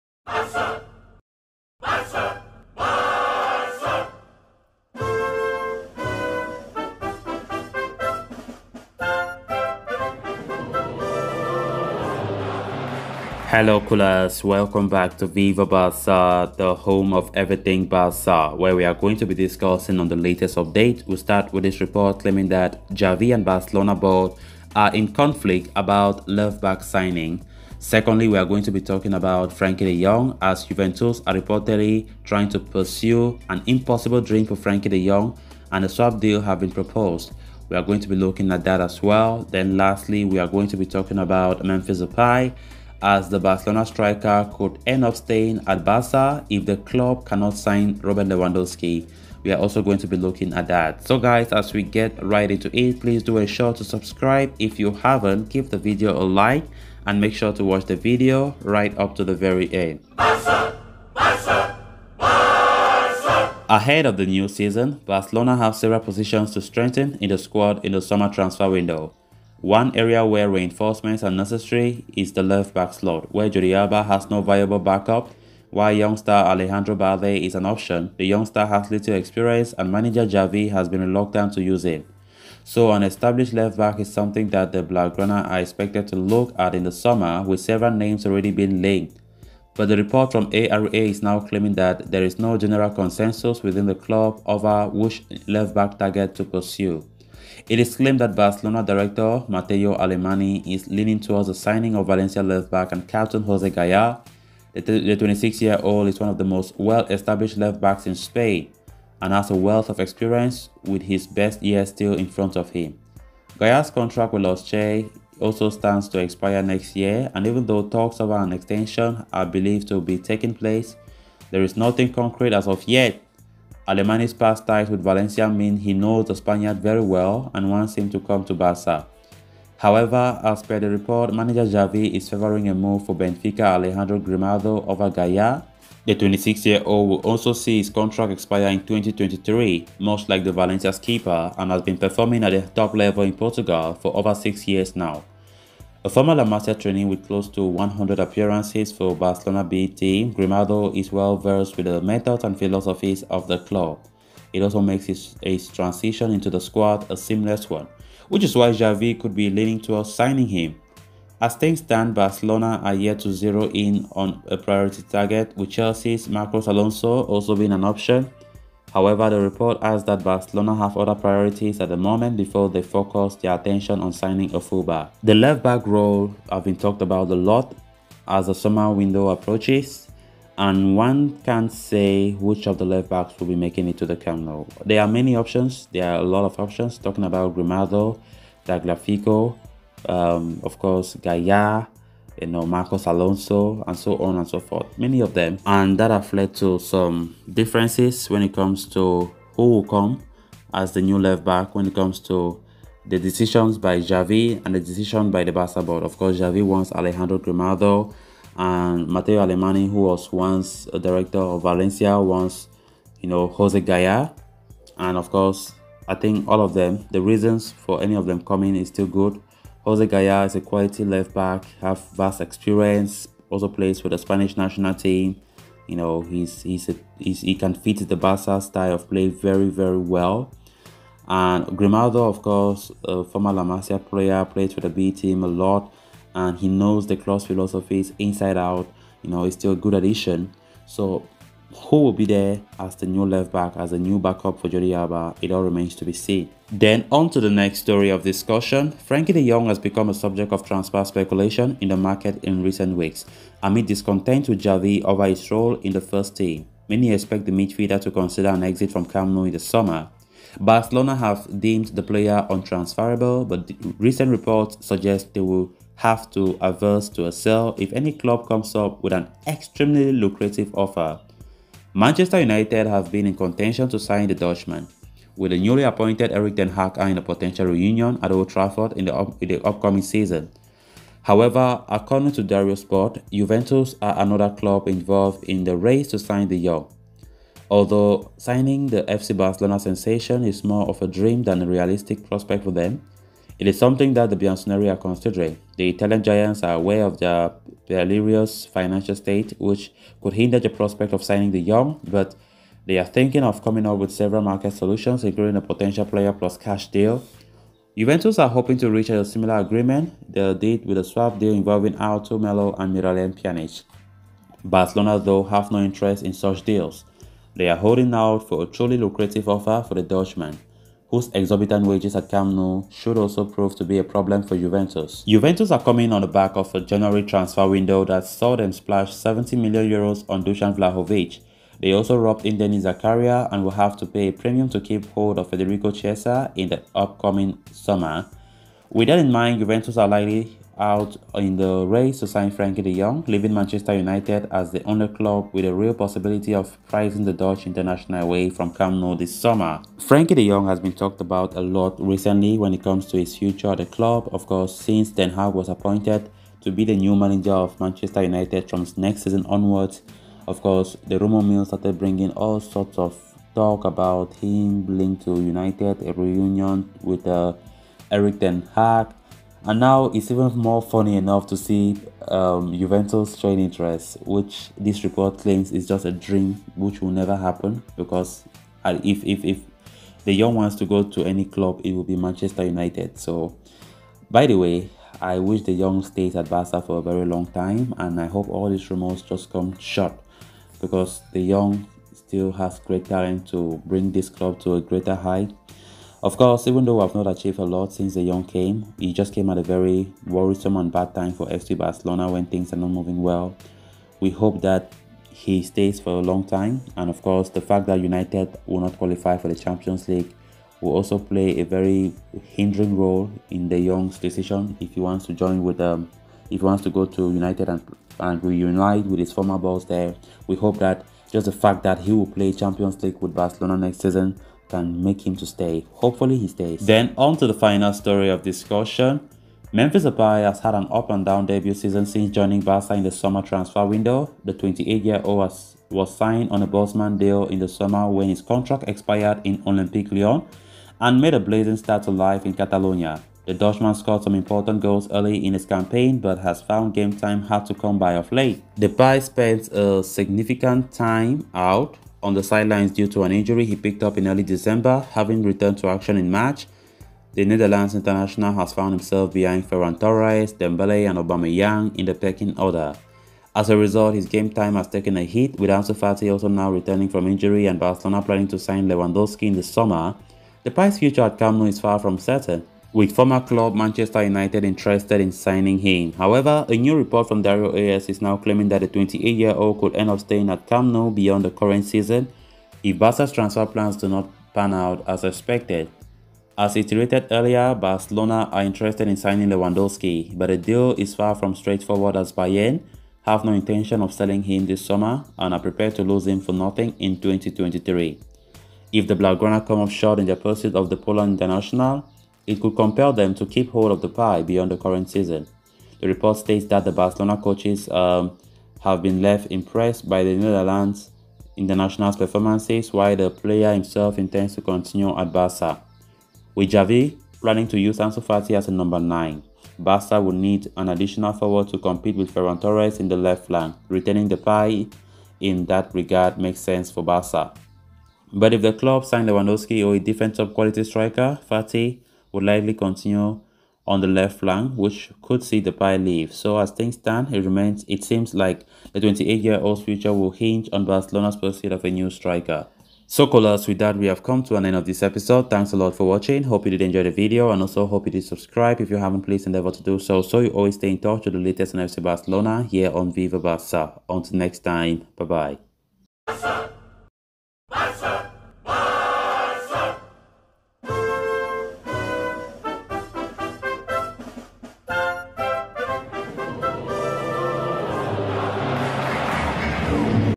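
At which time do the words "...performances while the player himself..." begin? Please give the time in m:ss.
8:32.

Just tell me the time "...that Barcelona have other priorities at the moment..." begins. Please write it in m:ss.
2:50.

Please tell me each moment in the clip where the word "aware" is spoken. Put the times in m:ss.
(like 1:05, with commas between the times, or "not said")
4:56.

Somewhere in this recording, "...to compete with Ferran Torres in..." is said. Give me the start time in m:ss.
8:41.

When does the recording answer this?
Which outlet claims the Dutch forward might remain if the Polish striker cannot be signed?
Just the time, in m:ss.
7:57.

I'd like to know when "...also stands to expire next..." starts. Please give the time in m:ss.
1:55.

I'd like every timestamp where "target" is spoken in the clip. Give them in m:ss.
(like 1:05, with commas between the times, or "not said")
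1:35, 2:45.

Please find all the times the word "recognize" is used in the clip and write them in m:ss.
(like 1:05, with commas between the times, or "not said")
not said.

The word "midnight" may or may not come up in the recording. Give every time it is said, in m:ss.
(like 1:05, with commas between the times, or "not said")
not said.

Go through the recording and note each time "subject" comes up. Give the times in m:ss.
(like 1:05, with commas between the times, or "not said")
4:10.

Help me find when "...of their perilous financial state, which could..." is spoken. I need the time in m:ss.
4:57.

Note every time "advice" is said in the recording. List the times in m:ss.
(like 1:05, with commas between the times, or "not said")
not said.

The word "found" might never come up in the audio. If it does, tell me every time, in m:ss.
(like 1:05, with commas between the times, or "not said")
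7:26, 7:38.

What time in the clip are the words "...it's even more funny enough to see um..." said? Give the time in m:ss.
6:10.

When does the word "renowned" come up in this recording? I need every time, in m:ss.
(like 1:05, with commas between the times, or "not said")
not said.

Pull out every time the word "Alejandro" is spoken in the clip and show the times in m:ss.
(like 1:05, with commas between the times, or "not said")
1:16, 2:13, 3:26.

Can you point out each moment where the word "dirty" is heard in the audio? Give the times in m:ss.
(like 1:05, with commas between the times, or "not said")
not said.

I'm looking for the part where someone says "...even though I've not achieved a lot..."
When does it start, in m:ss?
6:36.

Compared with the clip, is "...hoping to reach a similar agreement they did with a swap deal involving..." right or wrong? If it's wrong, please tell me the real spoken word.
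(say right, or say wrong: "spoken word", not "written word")
right.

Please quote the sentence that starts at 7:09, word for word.
Memphis Depay has had an up and down debut season since joining Barca in the summer transfer window.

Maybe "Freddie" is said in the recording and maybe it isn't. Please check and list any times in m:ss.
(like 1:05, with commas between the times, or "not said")
not said.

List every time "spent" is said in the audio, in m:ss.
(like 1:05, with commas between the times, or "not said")
7:29.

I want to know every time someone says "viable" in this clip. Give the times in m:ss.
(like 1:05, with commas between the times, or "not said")
1:14.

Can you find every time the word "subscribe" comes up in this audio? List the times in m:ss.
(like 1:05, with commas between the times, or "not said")
0:53, 9:08.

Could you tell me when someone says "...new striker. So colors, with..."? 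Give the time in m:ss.
9:01.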